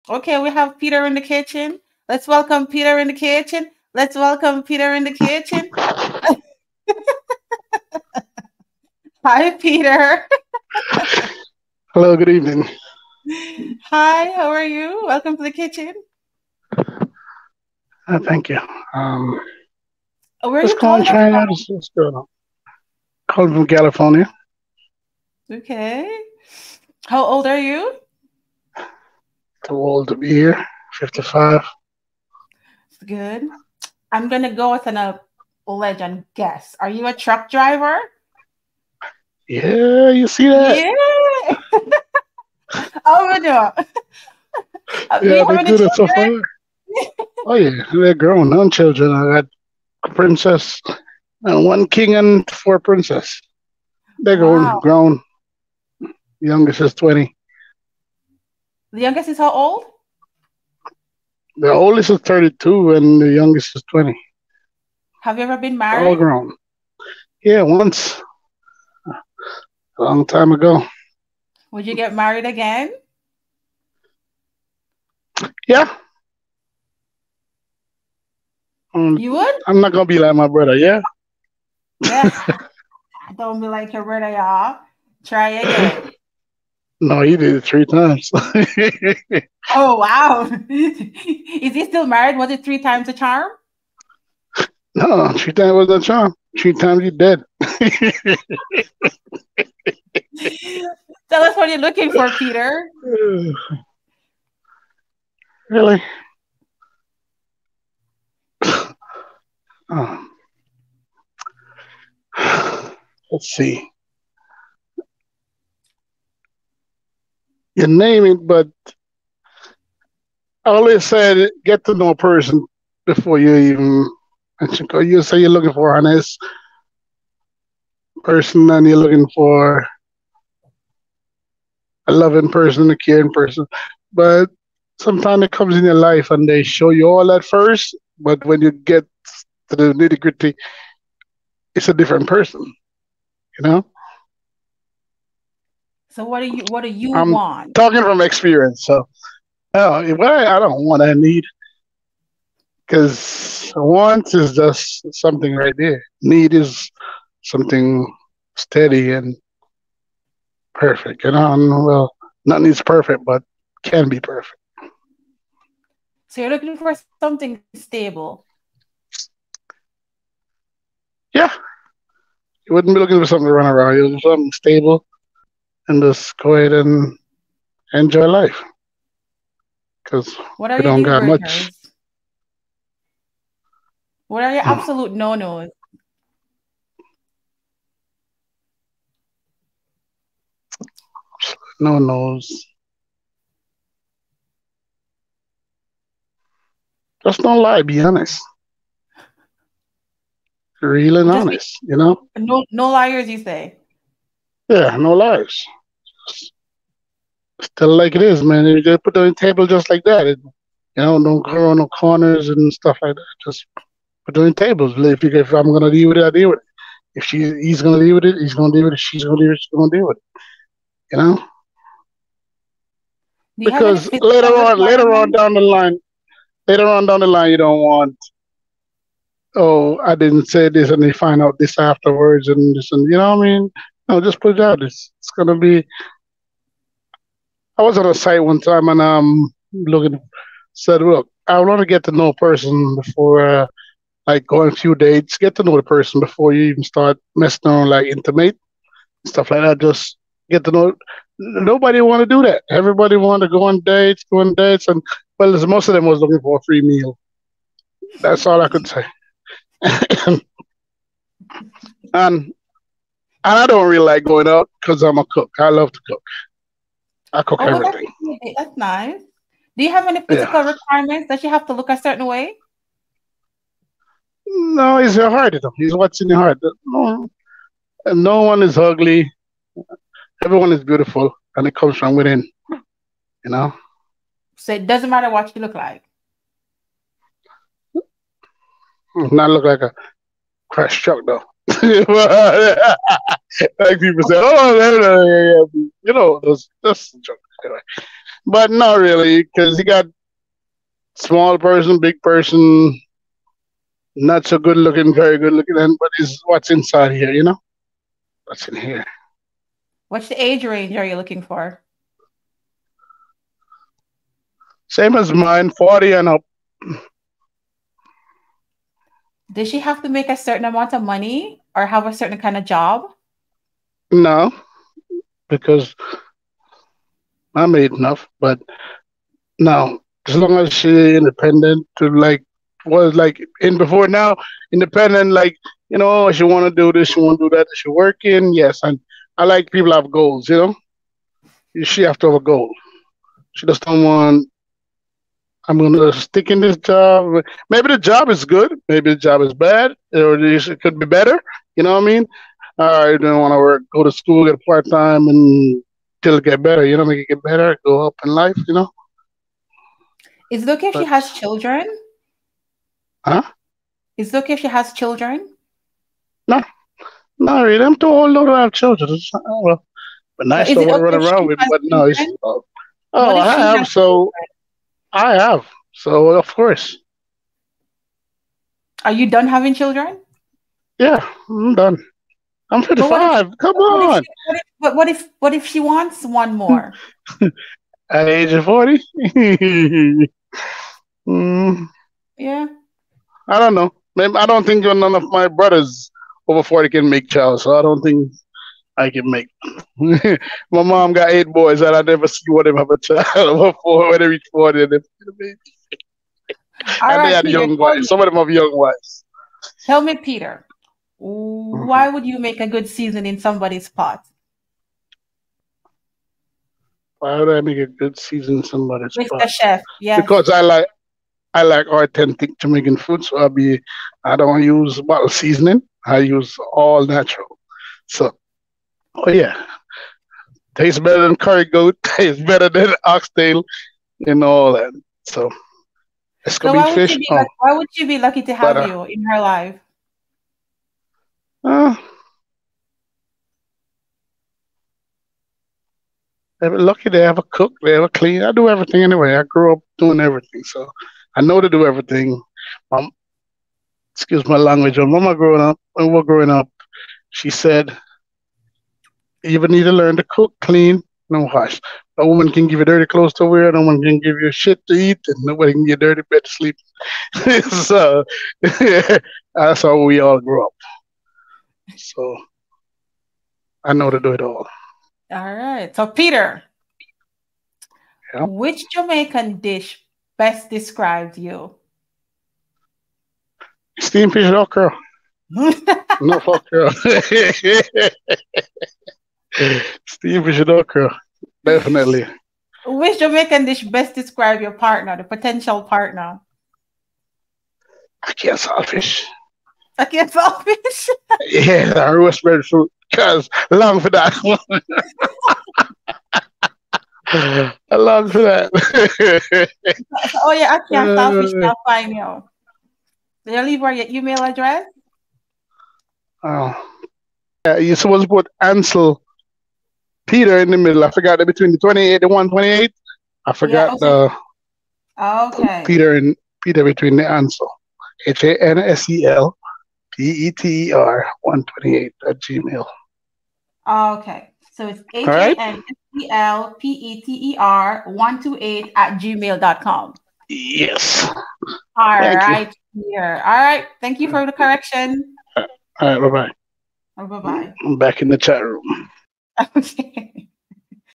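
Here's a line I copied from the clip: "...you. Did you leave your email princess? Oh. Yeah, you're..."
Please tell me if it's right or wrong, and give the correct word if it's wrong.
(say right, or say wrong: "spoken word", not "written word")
wrong: "address", not "princess".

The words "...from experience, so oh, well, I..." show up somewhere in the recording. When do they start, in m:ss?
2:28.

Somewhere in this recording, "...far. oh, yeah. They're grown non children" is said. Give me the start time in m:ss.
0:46.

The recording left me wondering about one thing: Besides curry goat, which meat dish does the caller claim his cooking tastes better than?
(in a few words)
Oxtail.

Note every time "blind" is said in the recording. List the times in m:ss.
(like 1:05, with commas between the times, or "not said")
not said.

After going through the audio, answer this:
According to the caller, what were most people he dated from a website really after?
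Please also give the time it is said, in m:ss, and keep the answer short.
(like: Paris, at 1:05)
A free meal, at 4:16.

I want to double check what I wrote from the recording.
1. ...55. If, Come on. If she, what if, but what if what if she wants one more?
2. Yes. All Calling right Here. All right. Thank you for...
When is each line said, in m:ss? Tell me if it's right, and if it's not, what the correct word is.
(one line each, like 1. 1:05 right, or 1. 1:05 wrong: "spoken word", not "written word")
1. 6:22 right
2. 9:00 wrong: "Thank", not "Calling".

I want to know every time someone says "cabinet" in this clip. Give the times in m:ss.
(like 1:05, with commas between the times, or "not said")
not said.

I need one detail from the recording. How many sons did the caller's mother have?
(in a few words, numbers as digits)
8.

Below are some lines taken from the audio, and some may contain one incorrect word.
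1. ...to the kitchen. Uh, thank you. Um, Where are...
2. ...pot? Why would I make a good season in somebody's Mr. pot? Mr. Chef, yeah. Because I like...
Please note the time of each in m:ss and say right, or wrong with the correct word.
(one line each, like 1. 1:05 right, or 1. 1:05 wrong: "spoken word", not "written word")
1. 0:15 right
2. 6:53 right.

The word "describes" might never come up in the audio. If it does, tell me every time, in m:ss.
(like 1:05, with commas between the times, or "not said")
8:00, 8:14.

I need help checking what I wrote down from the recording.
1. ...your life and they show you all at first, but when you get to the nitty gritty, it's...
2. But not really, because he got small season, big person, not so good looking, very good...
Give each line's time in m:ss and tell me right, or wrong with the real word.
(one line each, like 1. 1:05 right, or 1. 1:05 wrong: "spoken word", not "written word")
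1. 2:15 right
2. 4:58 wrong: "person", not "season".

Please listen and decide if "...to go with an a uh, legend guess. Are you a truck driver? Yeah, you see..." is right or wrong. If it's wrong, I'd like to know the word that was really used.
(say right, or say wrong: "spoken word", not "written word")
right.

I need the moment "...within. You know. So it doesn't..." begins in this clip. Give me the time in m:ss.
4:42.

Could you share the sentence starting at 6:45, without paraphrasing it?
and right, they had Peter, young wives.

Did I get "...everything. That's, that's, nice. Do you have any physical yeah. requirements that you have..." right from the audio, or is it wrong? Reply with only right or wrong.
right.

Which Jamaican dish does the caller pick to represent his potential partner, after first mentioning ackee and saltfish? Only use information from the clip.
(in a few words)
Roast breadfruit.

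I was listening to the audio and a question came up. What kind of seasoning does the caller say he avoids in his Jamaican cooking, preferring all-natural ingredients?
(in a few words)
Bottle seasoning.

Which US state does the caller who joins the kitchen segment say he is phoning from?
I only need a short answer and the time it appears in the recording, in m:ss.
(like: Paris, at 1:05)
California, at 0:23.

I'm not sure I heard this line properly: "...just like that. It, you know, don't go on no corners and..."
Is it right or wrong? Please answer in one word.
right.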